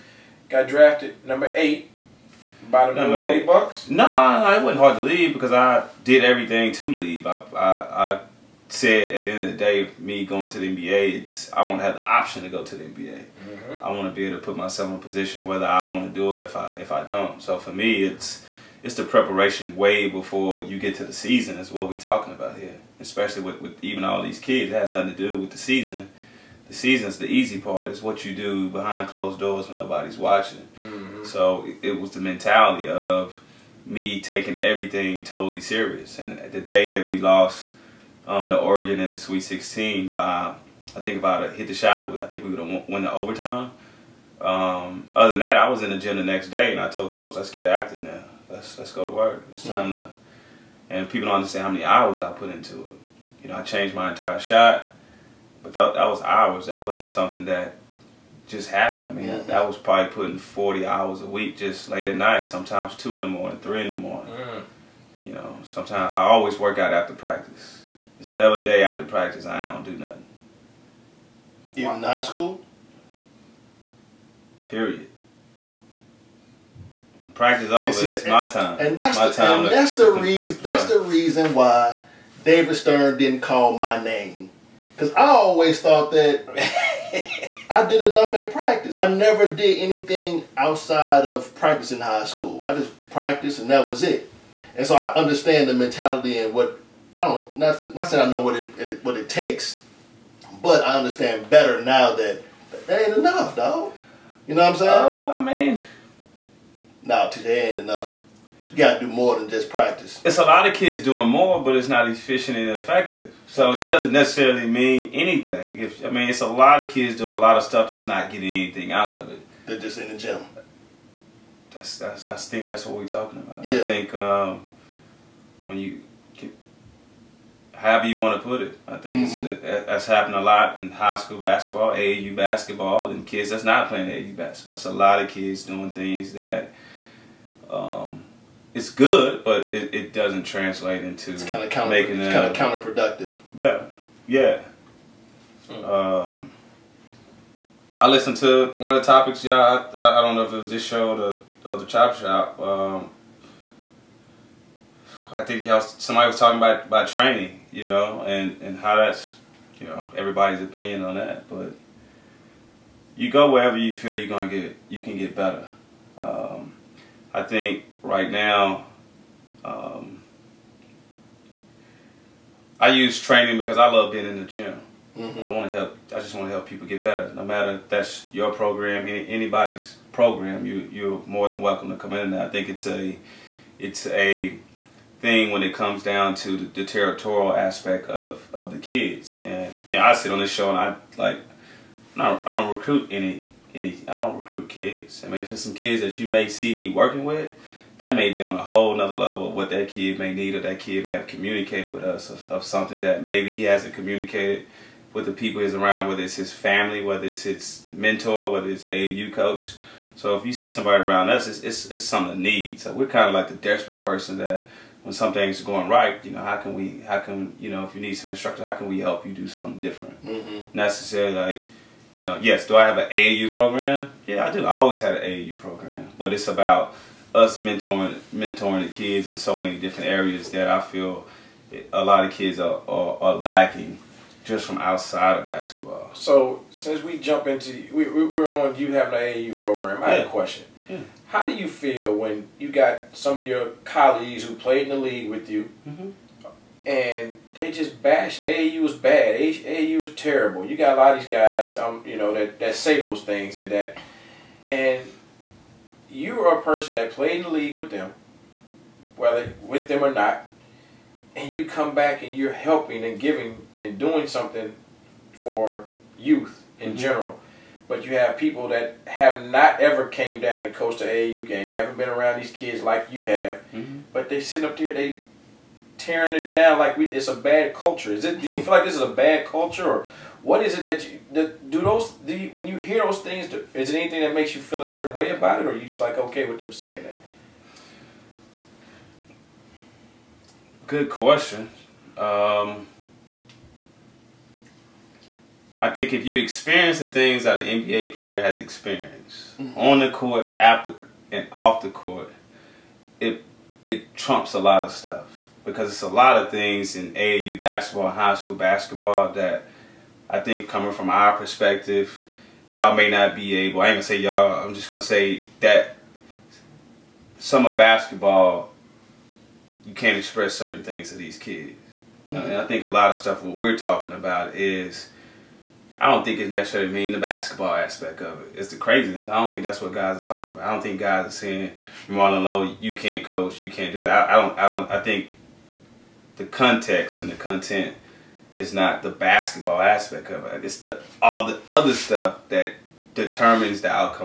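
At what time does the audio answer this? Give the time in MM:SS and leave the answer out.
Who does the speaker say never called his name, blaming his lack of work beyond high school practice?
01:22.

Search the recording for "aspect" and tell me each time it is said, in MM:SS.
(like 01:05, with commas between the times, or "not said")
03:07, 05:27, 05:39.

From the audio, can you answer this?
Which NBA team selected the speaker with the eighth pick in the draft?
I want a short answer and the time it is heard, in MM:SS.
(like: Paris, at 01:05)
Milwaukee Bucks, at 00:02.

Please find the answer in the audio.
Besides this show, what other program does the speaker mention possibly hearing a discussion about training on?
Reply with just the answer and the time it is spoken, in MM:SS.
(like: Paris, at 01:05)
the Chop Shop, at 02:31.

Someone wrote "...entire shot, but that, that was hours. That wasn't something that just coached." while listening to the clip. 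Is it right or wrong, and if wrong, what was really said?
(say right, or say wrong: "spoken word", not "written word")
wrong: "happened", not "coached".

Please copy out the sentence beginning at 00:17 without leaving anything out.
So for me, it's it's the preparation way before you get to the season is what we're talking about here.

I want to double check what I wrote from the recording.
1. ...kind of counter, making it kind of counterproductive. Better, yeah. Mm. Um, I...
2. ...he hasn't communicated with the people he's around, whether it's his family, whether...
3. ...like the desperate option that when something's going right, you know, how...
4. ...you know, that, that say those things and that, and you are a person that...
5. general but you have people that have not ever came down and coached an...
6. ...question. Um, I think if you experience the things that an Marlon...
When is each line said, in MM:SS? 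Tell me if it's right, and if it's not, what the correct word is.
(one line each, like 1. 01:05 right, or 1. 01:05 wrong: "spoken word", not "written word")
1. 02:21 right
2. 03:23 right
3. 03:33 wrong: "person", not "option"
4. 04:12 right
5. 04:26 right
6. 04:51 wrong: "NBA", not "Marlon".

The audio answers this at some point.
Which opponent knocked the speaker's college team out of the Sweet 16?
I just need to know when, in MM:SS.
00:38.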